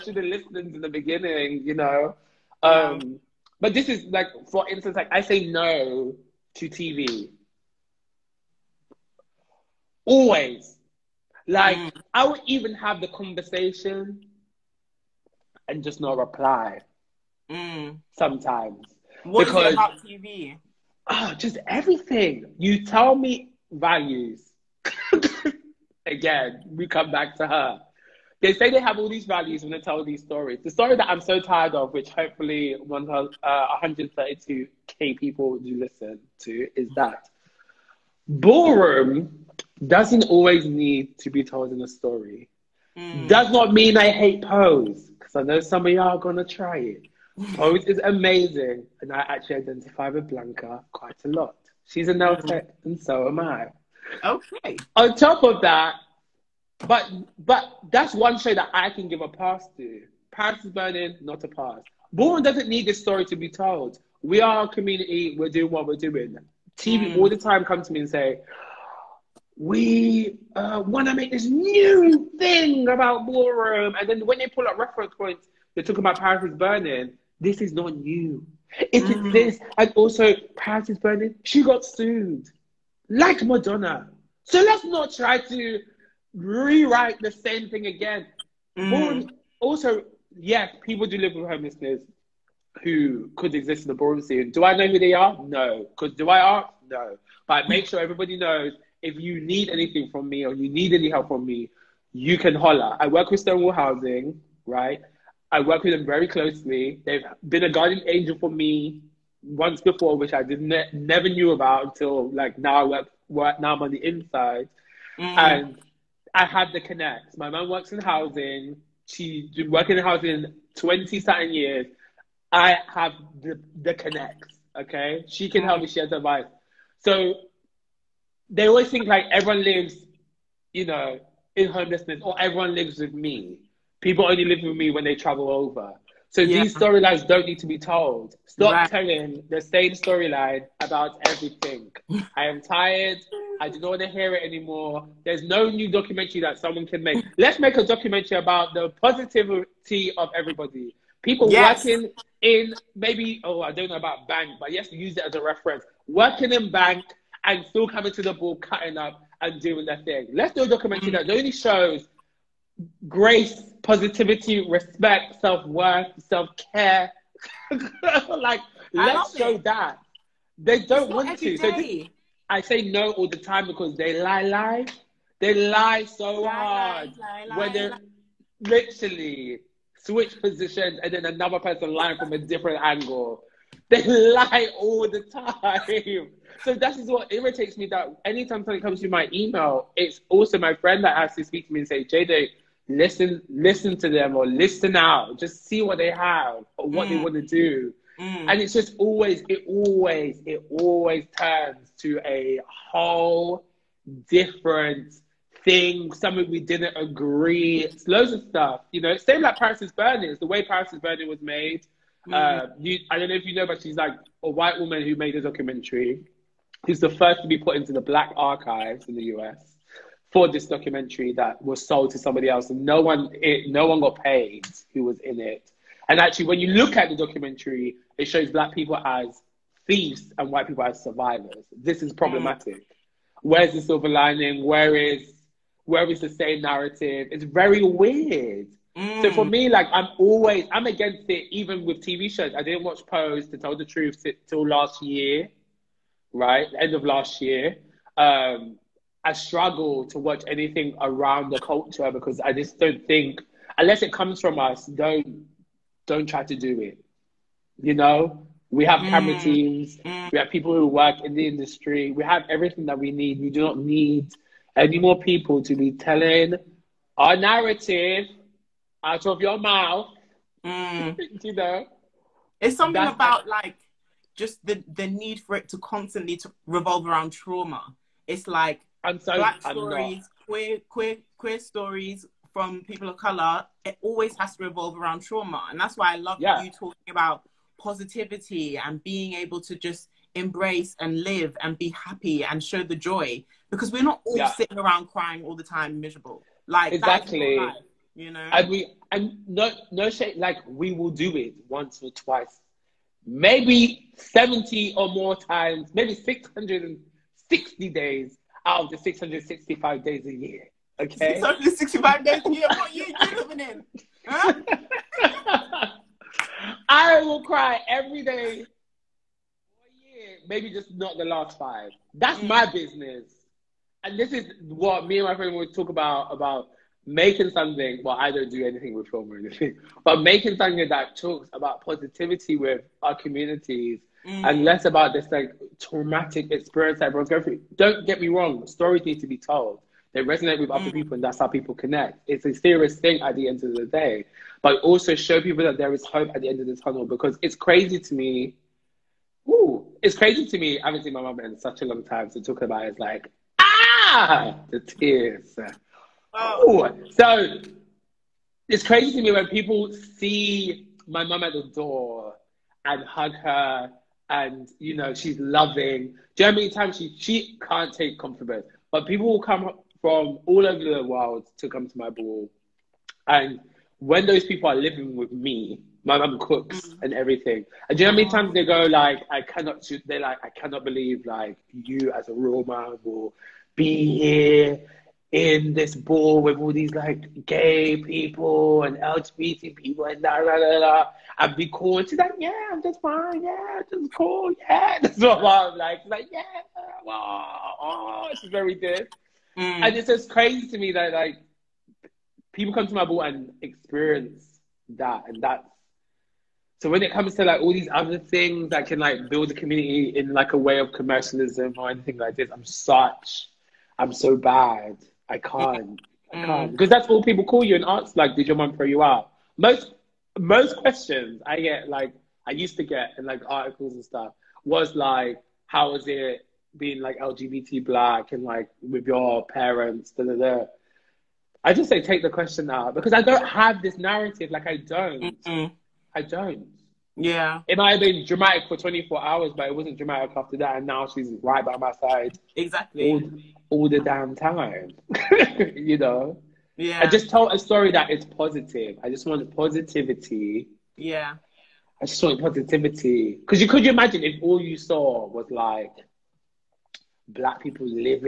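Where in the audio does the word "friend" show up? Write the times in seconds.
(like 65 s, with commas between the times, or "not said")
190 s, 325 s.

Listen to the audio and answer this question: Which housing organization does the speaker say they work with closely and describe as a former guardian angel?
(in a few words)
Stonewall Housing.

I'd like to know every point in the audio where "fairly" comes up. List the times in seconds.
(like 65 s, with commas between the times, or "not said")
not said.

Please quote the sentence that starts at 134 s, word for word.
People only live with me when they travel over.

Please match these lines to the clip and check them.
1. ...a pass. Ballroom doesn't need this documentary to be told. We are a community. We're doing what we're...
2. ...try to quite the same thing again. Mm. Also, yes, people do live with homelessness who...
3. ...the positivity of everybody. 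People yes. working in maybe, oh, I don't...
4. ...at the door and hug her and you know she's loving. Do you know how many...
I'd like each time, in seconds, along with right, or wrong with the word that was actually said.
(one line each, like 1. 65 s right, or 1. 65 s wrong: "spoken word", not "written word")
1. 61 s wrong: "story", not "documentary"
2. 85 s wrong: "rewrite", not "quite"
3. 148 s right
4. 361 s right.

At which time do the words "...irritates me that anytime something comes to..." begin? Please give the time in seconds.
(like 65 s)
187 s.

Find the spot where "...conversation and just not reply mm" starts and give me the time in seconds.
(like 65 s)
13 s.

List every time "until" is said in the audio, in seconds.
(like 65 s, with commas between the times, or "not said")
111 s.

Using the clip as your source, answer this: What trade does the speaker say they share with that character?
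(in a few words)
Nail tech.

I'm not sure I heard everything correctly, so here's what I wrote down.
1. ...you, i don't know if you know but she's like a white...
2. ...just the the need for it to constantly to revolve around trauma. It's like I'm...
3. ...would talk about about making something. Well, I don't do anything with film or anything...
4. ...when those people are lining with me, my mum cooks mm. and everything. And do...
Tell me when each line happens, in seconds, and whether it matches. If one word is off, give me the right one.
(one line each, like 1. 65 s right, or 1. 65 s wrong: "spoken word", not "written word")
1. 212 s right
2. 274 s right
3. 325 s right
4. 373 s wrong: "living", not "lining".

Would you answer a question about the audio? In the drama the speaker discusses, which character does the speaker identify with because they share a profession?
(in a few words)
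Blanca.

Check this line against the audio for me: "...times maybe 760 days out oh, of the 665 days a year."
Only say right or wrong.
wrong.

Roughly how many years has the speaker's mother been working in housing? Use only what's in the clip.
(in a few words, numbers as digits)
Twenty something years.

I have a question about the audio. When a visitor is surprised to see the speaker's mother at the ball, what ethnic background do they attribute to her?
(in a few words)
Roma.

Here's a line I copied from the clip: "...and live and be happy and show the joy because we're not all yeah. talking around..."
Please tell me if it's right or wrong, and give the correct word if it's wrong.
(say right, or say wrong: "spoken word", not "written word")
wrong: "sitting", not "talking".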